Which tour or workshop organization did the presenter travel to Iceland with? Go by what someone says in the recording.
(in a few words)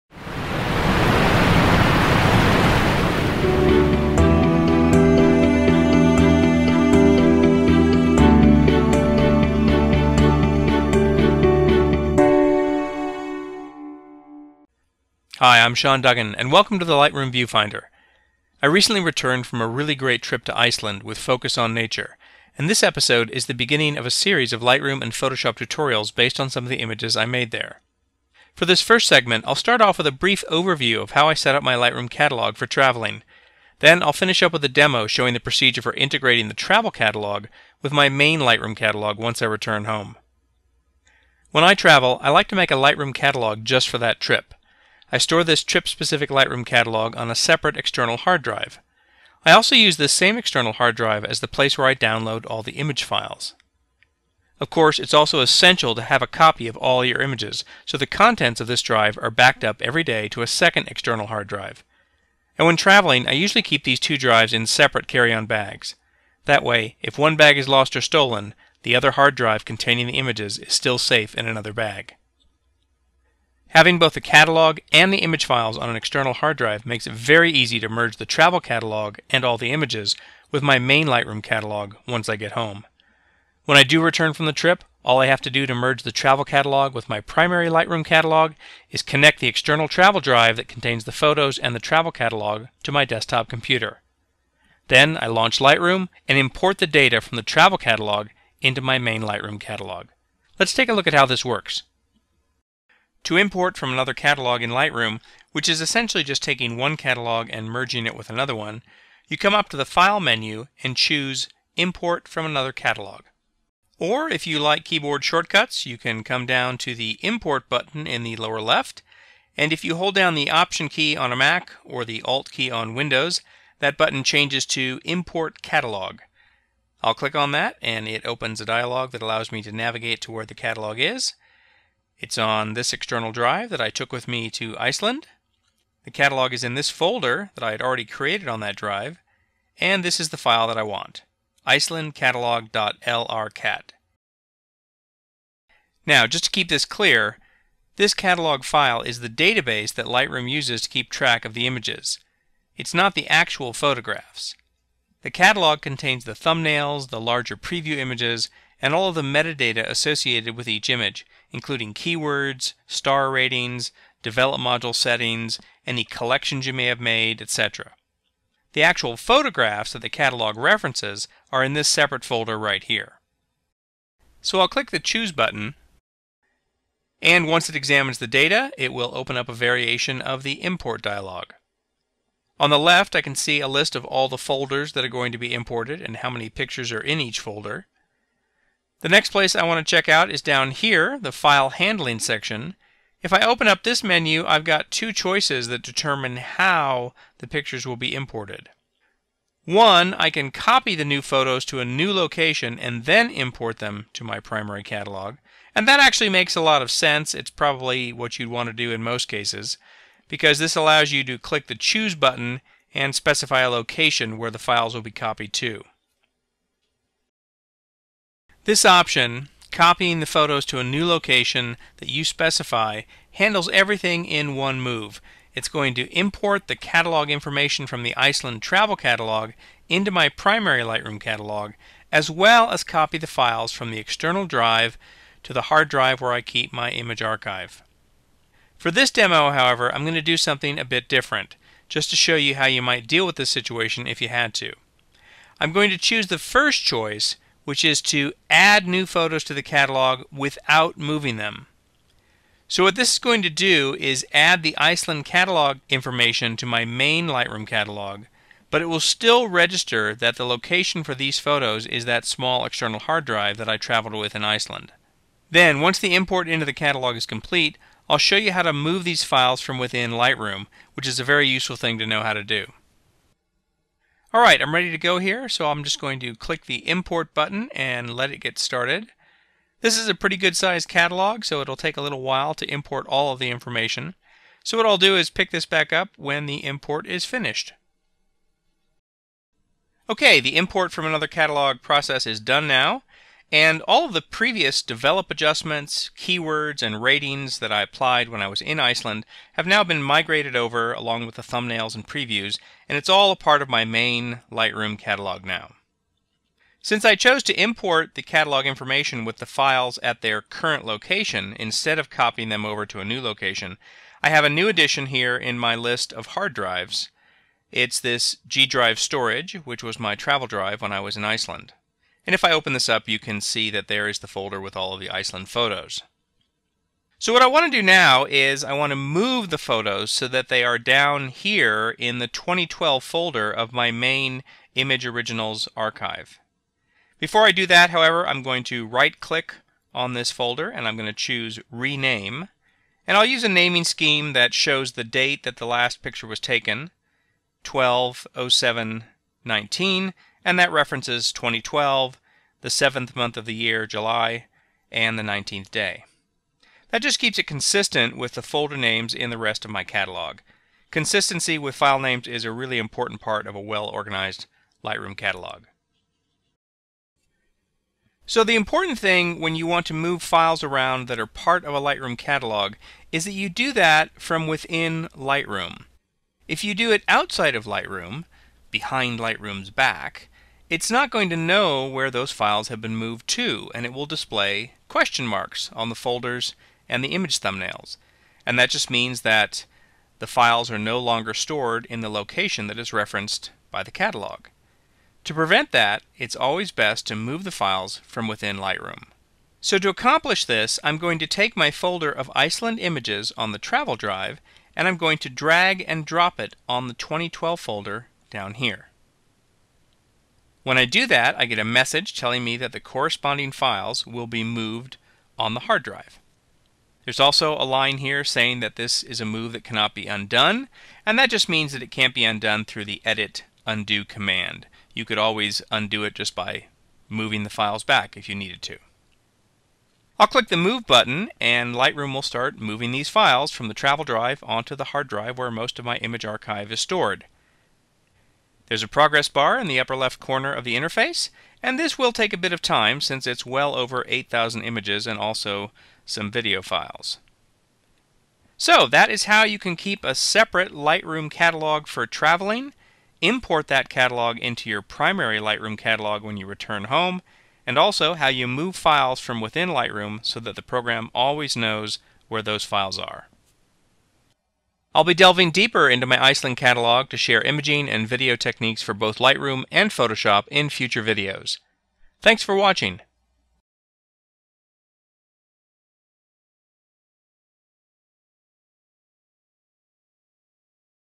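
Focus on Nature.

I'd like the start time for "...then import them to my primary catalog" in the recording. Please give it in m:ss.
3:23.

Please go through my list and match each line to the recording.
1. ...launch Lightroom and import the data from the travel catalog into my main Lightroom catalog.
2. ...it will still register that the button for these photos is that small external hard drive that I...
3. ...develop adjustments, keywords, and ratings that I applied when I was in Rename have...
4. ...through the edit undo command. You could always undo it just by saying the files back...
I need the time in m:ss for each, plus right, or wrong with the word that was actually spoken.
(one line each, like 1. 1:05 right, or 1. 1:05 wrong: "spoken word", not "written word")
1. 1:35 right
2. 4:18 wrong: "location", not "button"
3. 4:54 wrong: "Iceland", not "Rename"
4. 7:02 wrong: "moving", not "saying".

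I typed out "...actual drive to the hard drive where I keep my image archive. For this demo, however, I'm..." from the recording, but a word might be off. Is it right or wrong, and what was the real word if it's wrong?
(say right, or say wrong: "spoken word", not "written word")
wrong: "external", not "actual".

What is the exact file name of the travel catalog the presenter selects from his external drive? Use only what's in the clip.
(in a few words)
icelandcatalog.lrcat.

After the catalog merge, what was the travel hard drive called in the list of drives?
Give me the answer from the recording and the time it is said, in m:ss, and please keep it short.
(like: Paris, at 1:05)
G drive storage, at 5:18.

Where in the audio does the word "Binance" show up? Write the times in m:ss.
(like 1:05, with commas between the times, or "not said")
not said.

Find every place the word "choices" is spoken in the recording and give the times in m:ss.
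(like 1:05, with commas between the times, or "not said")
3:15, 4:06.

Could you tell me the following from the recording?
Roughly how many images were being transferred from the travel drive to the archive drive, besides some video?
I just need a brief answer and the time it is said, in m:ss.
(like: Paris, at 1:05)
over 8,000, at 7:23.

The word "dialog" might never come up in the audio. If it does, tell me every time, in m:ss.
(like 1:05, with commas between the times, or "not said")
2:08, 3:01.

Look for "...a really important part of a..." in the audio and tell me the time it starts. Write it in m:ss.
6:02.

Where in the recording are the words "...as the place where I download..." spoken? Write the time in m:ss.
0:51.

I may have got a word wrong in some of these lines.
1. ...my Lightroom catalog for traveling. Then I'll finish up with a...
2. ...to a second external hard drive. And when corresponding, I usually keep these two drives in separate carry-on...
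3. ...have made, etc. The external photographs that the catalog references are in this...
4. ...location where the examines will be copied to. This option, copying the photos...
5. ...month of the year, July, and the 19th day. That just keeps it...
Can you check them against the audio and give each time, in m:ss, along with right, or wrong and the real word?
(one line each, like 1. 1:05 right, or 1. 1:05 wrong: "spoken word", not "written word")
1. 0:31 right
2. 1:00 wrong: "traveling", not "corresponding"
3. 2:46 wrong: "actual", not "external"
4. 3:33 wrong: "files", not "examines"
5. 5:53 right.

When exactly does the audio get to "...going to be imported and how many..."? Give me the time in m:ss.
3:05.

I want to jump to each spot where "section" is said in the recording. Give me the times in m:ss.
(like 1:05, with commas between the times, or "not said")
3:12.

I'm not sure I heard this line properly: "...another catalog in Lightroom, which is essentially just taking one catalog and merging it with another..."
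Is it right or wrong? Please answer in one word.
right.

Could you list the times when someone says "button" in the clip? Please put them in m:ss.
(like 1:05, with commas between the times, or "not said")
1:57, 2:03, 2:55, 3:32, 4:37, 7:10.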